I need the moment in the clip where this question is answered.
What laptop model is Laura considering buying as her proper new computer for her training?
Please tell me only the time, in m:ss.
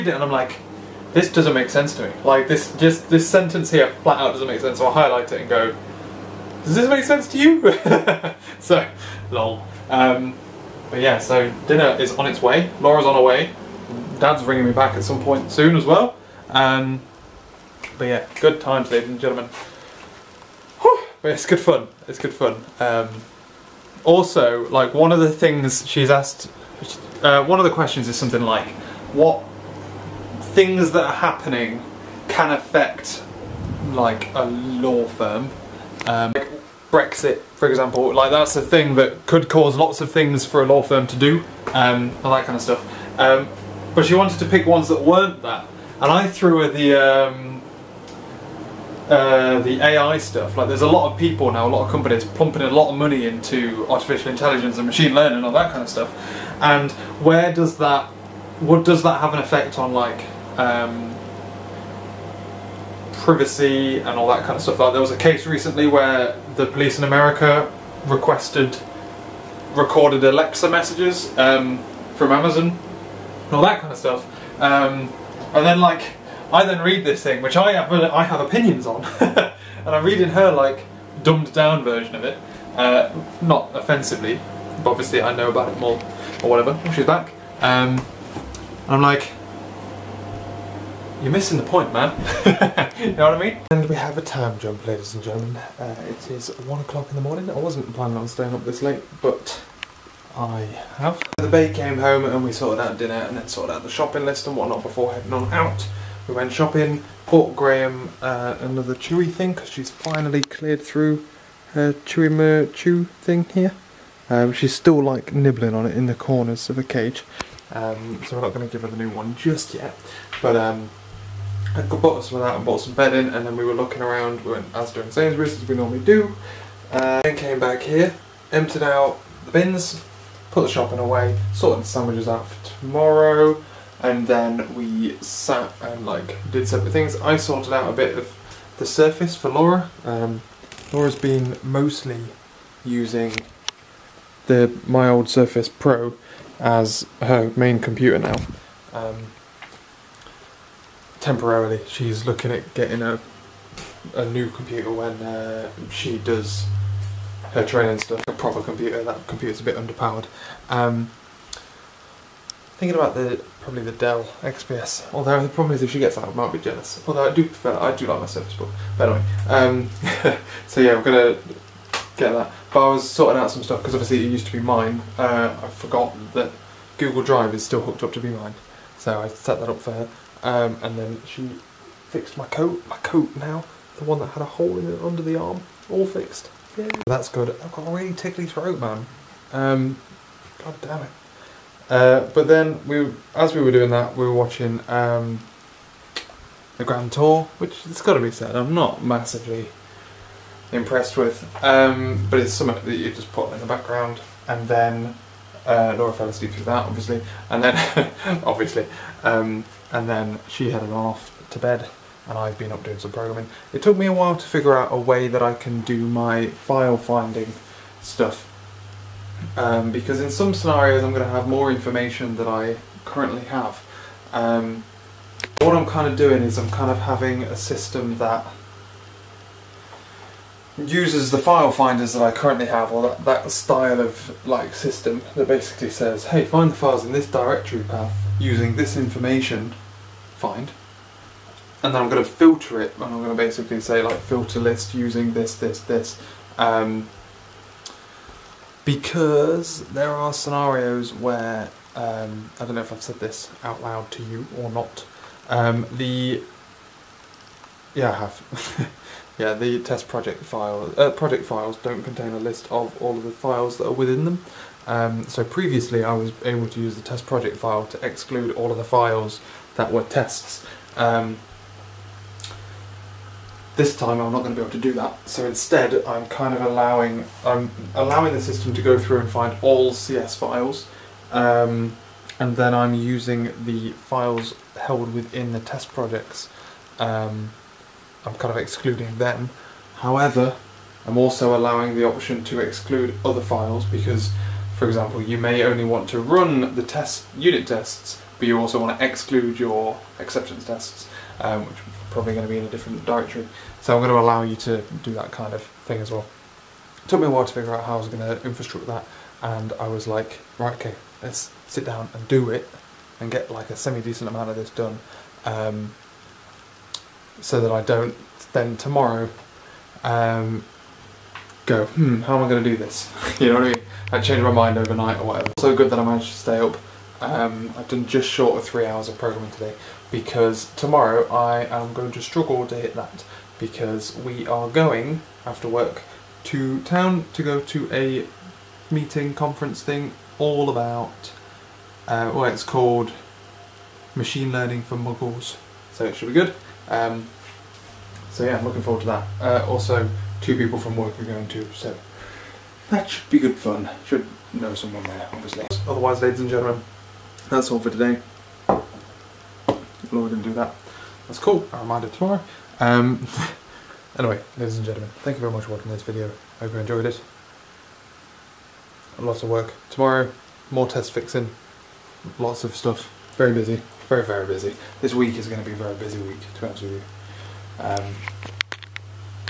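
2:43.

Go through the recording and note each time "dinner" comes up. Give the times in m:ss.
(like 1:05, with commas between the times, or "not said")
0:11, 1:42.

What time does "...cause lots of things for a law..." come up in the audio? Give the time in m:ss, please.
0:39.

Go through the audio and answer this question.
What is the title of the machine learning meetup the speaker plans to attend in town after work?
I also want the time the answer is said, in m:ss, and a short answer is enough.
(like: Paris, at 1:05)
Machine Learning for Muggles, at 5:44.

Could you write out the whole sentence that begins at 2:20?
Um, Laura's been mostly using the my old Surface Pro as her main computer now.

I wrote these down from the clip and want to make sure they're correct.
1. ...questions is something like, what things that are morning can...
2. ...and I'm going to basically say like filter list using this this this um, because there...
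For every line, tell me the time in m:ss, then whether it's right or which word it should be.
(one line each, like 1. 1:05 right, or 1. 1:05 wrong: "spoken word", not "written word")
1. 0:27 wrong: "happening", not "morning"
2. 4:02 right.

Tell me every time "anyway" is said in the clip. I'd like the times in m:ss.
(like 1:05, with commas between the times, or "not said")
2:49, 6:04.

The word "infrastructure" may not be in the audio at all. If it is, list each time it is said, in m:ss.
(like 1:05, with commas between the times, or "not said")
5:08.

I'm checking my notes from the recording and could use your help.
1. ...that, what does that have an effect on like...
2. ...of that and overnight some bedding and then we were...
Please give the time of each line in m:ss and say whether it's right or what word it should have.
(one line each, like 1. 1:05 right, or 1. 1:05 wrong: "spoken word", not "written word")
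1. 0:57 right
2. 2:02 wrong: "bought", not "overnight".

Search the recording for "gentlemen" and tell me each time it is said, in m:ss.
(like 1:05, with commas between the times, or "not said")
0:19, 1:35, 5:56, 6:04.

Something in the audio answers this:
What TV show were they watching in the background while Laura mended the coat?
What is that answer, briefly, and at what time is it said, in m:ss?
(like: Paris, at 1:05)
The Grand Tour, at 3:16.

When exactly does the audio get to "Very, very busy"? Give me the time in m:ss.
6:14.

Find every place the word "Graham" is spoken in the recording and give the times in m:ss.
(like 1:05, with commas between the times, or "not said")
1:47.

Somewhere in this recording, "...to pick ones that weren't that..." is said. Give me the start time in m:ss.
0:44.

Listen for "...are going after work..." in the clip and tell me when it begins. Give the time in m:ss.
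5:34.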